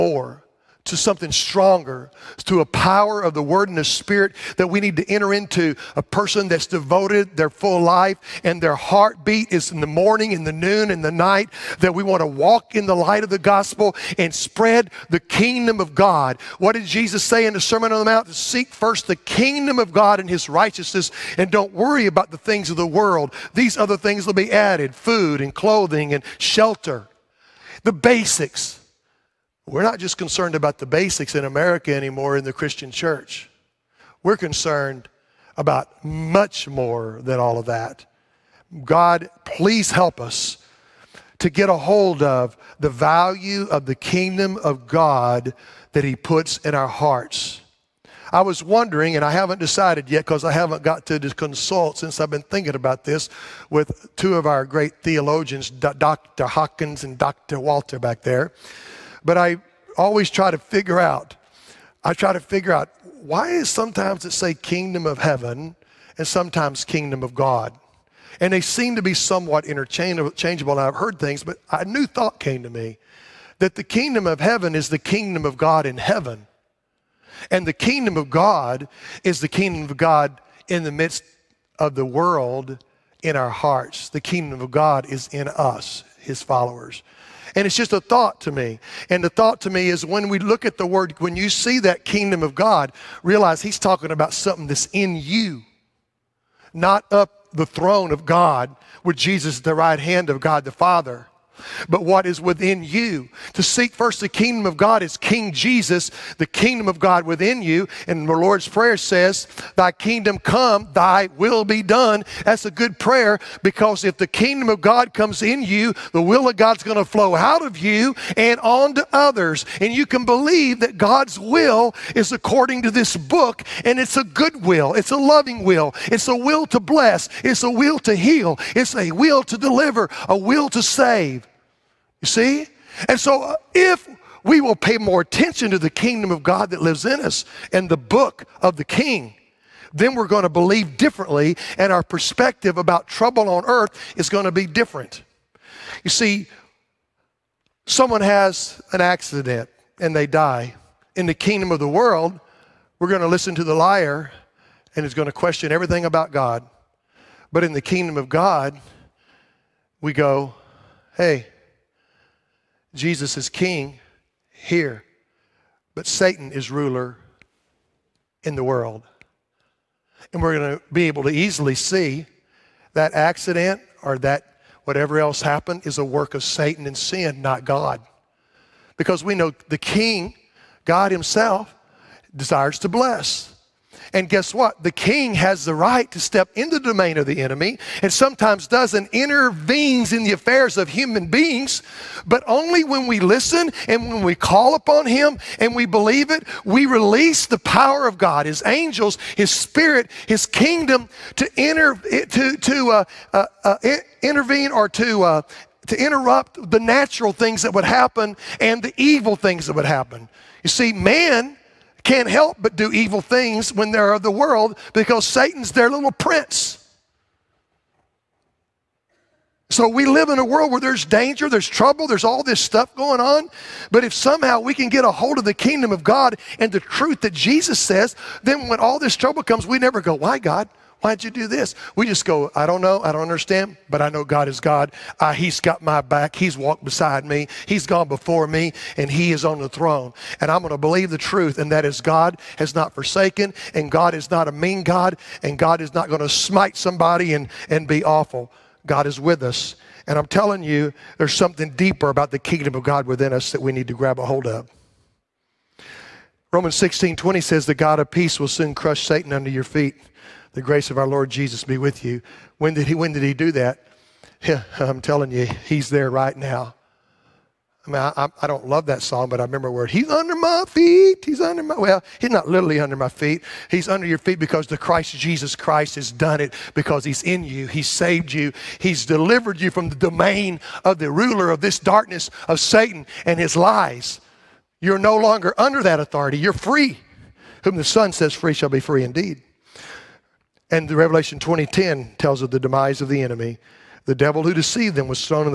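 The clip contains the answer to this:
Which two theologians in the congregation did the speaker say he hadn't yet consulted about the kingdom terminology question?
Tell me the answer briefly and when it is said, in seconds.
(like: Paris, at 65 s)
Dr. Hawkins and Dr. Walter, at 55 s.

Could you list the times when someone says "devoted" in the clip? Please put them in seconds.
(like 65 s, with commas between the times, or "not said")
6 s.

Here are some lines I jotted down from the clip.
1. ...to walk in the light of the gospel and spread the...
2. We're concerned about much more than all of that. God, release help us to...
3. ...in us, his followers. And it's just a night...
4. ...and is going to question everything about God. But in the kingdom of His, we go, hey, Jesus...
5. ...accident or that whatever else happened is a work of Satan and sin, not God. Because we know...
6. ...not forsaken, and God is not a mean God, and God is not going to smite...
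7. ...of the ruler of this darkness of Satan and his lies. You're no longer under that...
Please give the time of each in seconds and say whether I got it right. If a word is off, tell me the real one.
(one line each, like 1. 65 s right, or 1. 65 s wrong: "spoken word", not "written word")
1. 12 s right
2. 34 s wrong: "please", not "release"
3. 85 s wrong: "thought", not "night"
4. 154 s wrong: "God", not "His"
5. 173 s right
6. 242 s right
7. 280 s right.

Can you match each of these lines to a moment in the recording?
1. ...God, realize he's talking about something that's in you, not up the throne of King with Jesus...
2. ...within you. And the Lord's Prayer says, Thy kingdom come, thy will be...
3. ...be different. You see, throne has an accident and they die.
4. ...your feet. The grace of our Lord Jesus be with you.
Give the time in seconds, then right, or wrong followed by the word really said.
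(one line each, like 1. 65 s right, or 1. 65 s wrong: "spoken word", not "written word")
1. 92 s wrong: "God", not "King"
2. 107 s right
3. 144 s wrong: "someone", not "throne"
4. 259 s right.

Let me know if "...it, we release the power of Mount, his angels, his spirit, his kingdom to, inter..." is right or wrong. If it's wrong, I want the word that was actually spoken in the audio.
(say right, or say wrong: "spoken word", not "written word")
wrong: "God", not "Mount".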